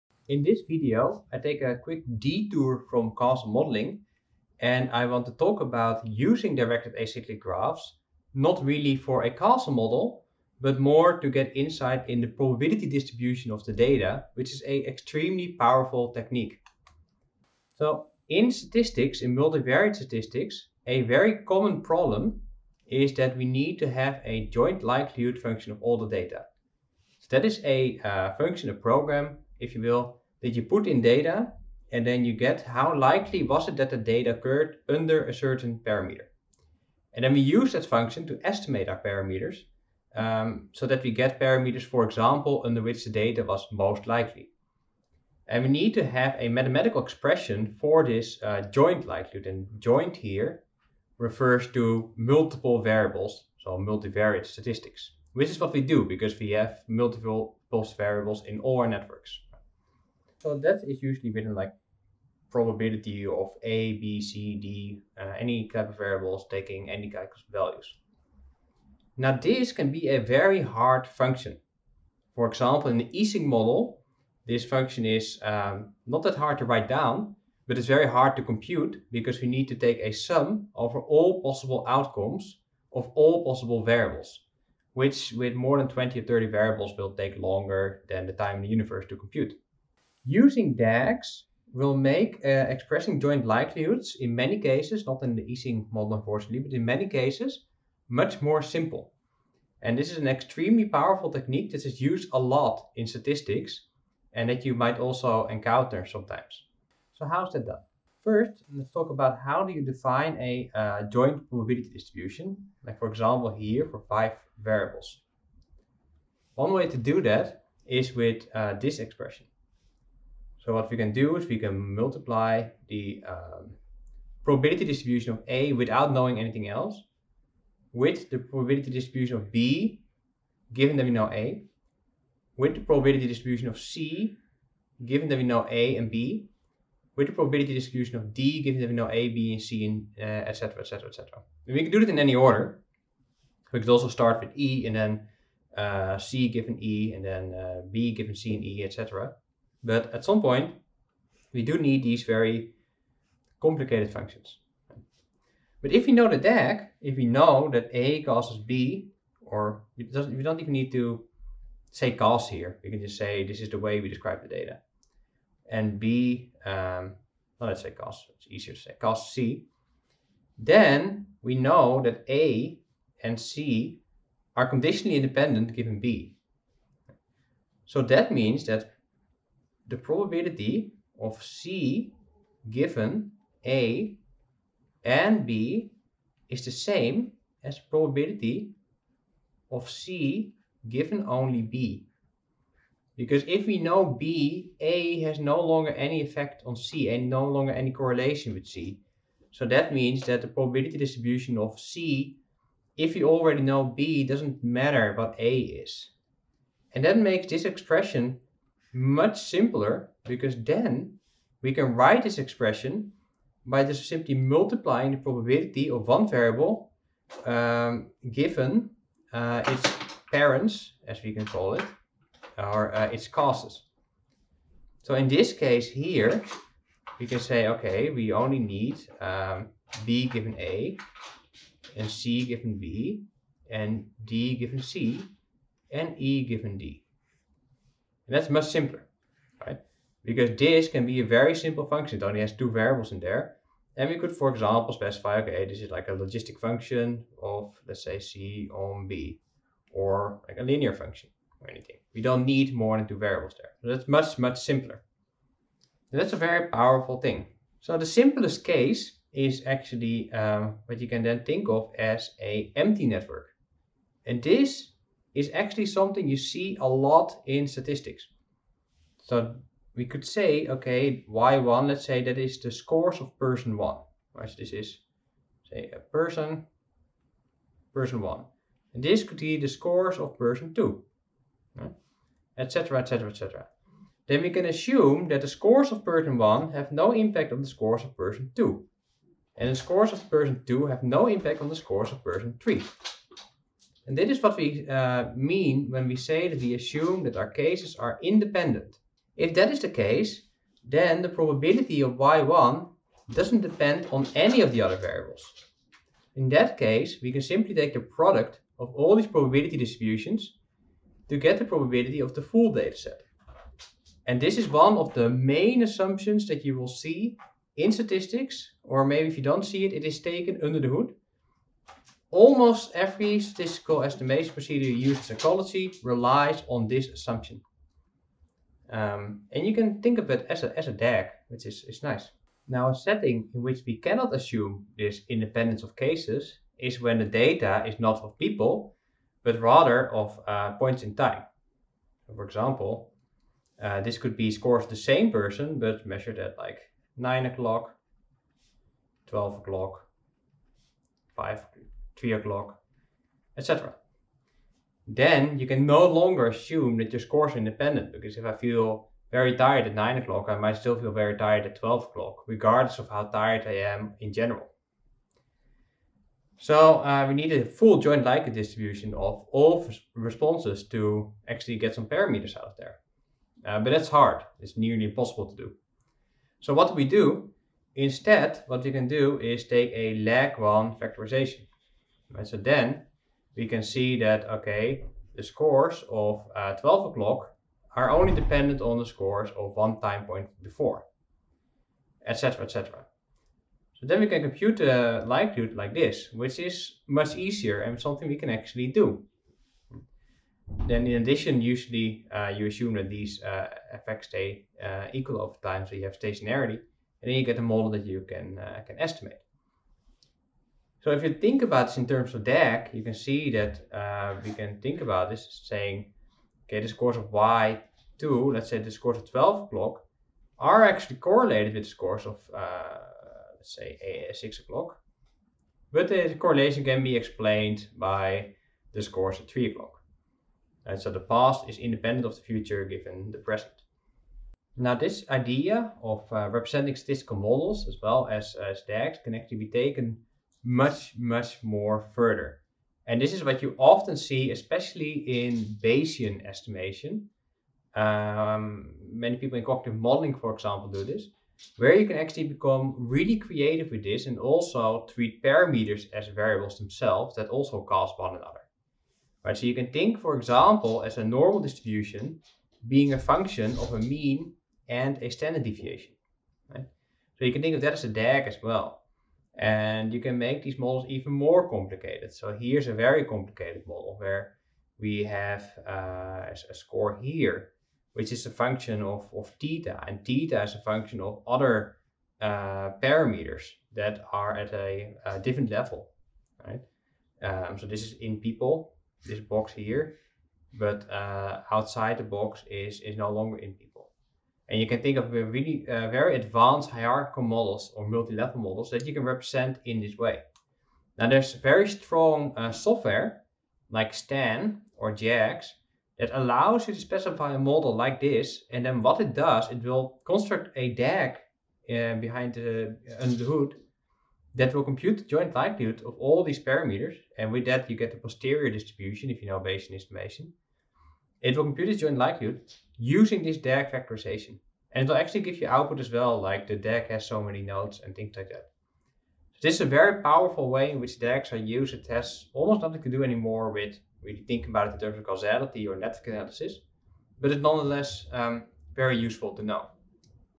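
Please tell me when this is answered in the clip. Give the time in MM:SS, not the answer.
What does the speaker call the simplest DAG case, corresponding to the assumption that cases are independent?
04:22.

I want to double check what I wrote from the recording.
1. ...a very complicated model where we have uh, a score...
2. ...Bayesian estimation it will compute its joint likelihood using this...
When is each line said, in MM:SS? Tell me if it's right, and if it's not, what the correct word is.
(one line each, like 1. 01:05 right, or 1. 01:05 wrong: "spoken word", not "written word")
1. 07:52 right
2. 08:39 right.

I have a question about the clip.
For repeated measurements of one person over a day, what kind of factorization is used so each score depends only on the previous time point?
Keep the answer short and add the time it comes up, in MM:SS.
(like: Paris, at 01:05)
lag 1 factorization, at 06:20.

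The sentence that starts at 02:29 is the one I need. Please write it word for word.
But at some point, we do need these very complicated functions.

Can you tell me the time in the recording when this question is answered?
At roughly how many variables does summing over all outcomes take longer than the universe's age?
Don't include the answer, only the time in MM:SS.
01:25.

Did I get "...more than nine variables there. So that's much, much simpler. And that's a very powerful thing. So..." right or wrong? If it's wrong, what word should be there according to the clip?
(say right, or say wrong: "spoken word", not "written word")
wrong: "two", not "nine".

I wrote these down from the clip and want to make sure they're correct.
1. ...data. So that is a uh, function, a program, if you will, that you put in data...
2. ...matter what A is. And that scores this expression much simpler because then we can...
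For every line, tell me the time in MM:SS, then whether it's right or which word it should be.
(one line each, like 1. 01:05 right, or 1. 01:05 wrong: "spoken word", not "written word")
1. 00:26 right
2. 03:24 wrong: "makes", not "scores".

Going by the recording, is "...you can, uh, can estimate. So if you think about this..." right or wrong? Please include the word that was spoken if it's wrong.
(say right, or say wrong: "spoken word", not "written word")
right.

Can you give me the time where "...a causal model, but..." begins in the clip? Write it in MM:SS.
00:09.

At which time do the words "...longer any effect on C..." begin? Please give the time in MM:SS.
03:15.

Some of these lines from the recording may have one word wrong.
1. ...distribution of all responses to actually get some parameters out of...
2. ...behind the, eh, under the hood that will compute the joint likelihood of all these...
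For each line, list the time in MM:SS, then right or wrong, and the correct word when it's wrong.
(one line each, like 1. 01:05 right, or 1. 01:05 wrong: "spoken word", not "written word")
1. 06:08 right
2. 08:32 right.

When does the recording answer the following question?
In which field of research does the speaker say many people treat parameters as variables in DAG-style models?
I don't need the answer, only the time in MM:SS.
07:29.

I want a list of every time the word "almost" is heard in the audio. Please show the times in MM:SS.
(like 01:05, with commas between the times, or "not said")
05:22, 08:52.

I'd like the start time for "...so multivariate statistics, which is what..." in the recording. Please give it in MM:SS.
00:53.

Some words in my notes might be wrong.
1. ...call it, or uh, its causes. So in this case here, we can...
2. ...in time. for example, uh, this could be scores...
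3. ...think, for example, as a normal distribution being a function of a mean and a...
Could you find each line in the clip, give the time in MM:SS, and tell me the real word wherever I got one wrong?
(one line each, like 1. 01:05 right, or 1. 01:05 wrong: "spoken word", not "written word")
1. 03:41 right
2. 05:41 right
3. 07:39 right.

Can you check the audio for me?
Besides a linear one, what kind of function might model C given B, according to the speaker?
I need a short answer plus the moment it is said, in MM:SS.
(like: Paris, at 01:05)
logistic function, at 04:06.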